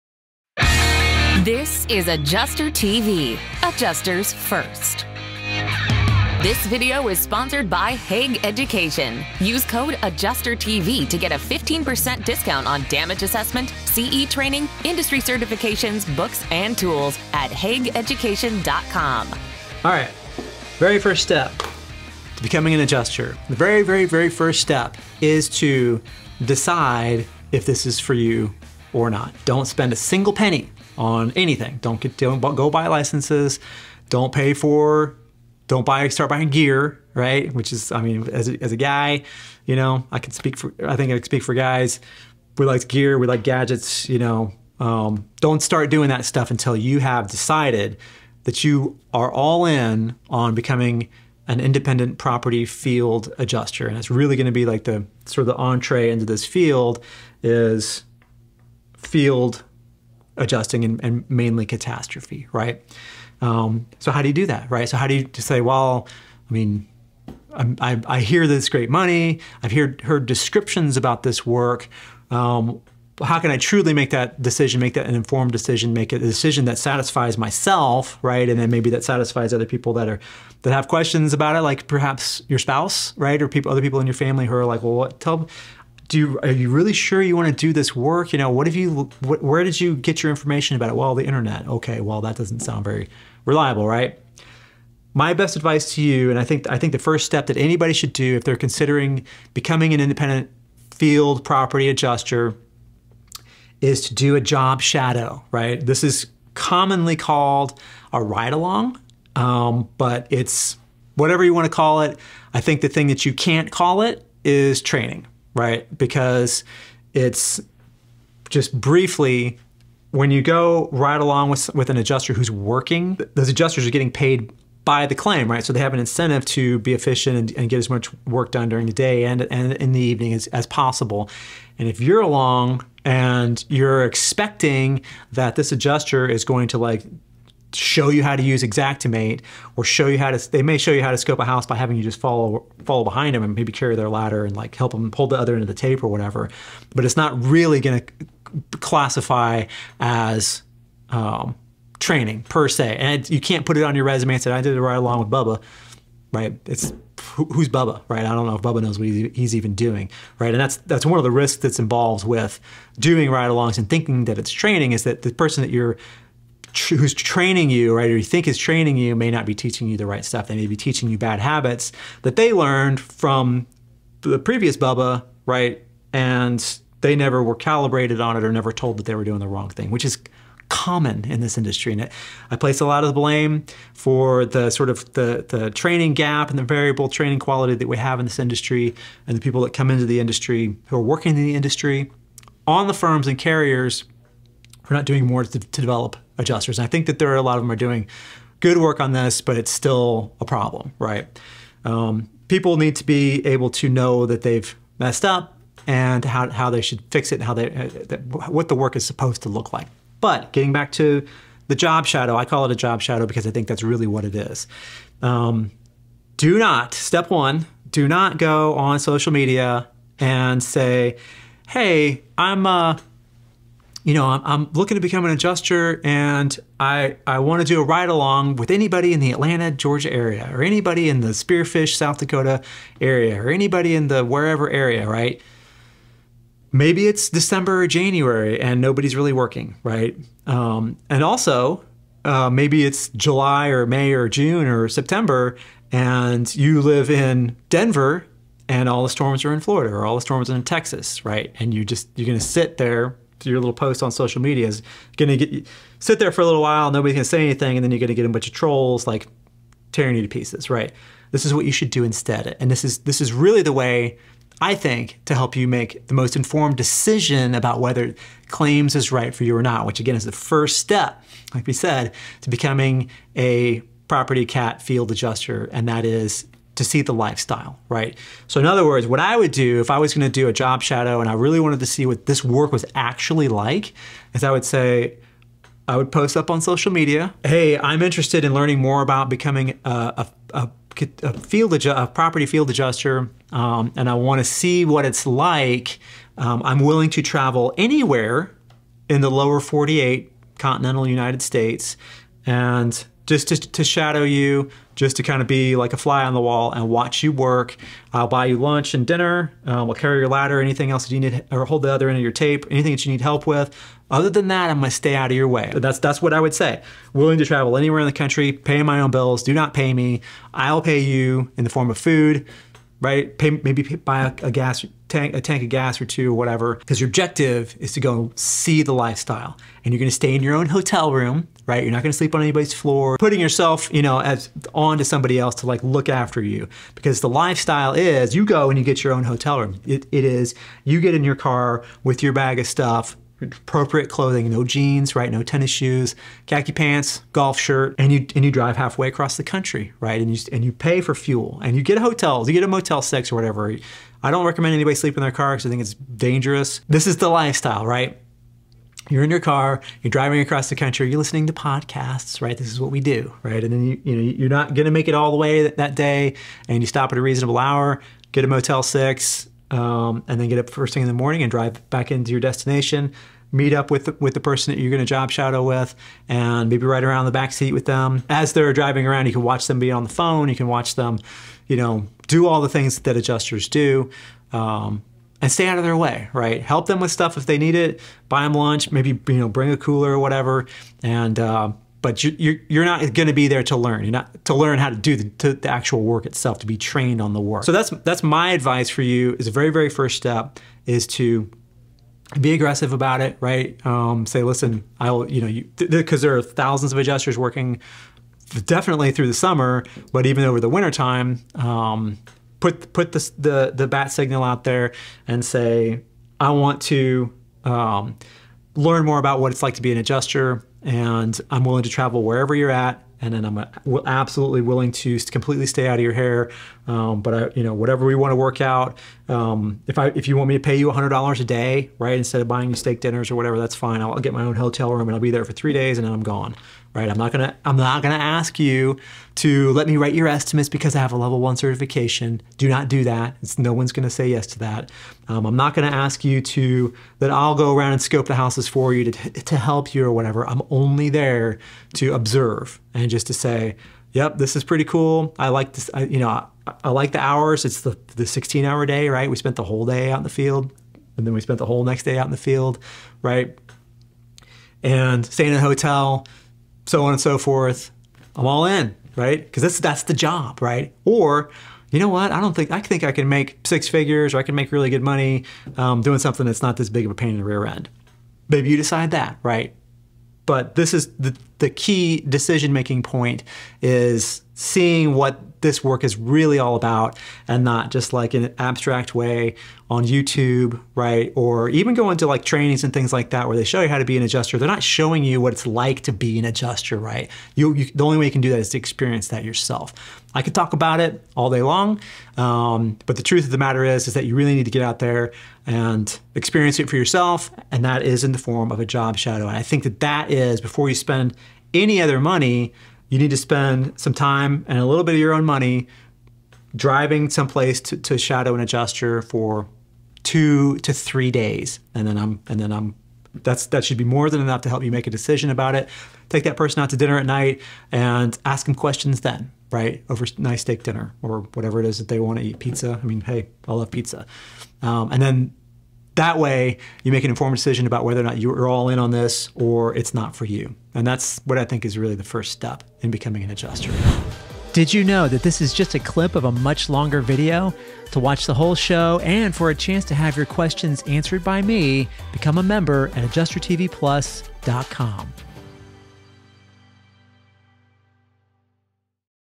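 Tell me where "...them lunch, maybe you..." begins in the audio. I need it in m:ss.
6:28.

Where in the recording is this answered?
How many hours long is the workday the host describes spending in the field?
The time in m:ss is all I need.
7:38.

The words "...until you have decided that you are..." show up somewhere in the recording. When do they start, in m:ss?
0:46.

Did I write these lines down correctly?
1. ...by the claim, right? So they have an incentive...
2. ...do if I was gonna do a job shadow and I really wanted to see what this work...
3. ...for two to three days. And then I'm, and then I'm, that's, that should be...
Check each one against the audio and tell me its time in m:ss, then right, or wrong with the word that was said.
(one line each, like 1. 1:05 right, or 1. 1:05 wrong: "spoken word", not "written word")
1. 2:04 right
2. 4:39 right
3. 8:39 right.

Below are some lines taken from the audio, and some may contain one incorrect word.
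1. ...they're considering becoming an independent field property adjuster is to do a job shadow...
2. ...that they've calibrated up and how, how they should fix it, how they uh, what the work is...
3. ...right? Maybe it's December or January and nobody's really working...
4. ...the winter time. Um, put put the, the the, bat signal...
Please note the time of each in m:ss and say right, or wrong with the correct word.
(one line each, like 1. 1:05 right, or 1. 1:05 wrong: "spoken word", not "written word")
1. 1:38 right
2. 3:24 wrong: "messed", not "calibrated"
3. 3:55 right
4. 6:50 right.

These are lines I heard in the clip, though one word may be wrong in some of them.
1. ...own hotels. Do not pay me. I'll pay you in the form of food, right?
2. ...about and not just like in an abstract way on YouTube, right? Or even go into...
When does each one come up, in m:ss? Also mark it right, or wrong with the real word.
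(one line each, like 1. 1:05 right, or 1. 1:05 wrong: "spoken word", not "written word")
1. 5:18 wrong: "bills", not "hotels"
2. 8:06 right.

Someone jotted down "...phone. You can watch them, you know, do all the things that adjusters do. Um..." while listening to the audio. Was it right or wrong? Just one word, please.
right.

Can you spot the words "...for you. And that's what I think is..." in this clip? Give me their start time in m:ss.
9:00.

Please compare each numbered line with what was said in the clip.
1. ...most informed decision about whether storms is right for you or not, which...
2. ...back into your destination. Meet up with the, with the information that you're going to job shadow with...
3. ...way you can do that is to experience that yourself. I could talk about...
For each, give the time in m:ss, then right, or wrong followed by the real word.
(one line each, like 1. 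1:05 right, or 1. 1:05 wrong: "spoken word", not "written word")
1. 4:26 wrong: "claims", not "storms"
2. 6:11 wrong: "person", not "information"
3. 8:18 right.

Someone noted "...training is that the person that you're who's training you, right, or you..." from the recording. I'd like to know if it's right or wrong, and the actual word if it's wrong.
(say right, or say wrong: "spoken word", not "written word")
right.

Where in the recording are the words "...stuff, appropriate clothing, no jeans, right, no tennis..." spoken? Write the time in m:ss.
5:42.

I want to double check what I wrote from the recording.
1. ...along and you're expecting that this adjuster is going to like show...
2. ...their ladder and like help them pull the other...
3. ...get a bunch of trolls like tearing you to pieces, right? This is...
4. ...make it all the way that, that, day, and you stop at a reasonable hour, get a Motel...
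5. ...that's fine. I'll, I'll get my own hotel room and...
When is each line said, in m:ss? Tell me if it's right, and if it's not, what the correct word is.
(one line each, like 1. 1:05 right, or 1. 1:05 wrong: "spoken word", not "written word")
1. 2:12 right
2. 2:23 right
3. 4:18 right
4. 6:04 right
5. 7:13 right.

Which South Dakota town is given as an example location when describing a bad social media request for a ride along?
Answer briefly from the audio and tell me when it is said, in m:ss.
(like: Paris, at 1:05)
Spearfish, at 3:51.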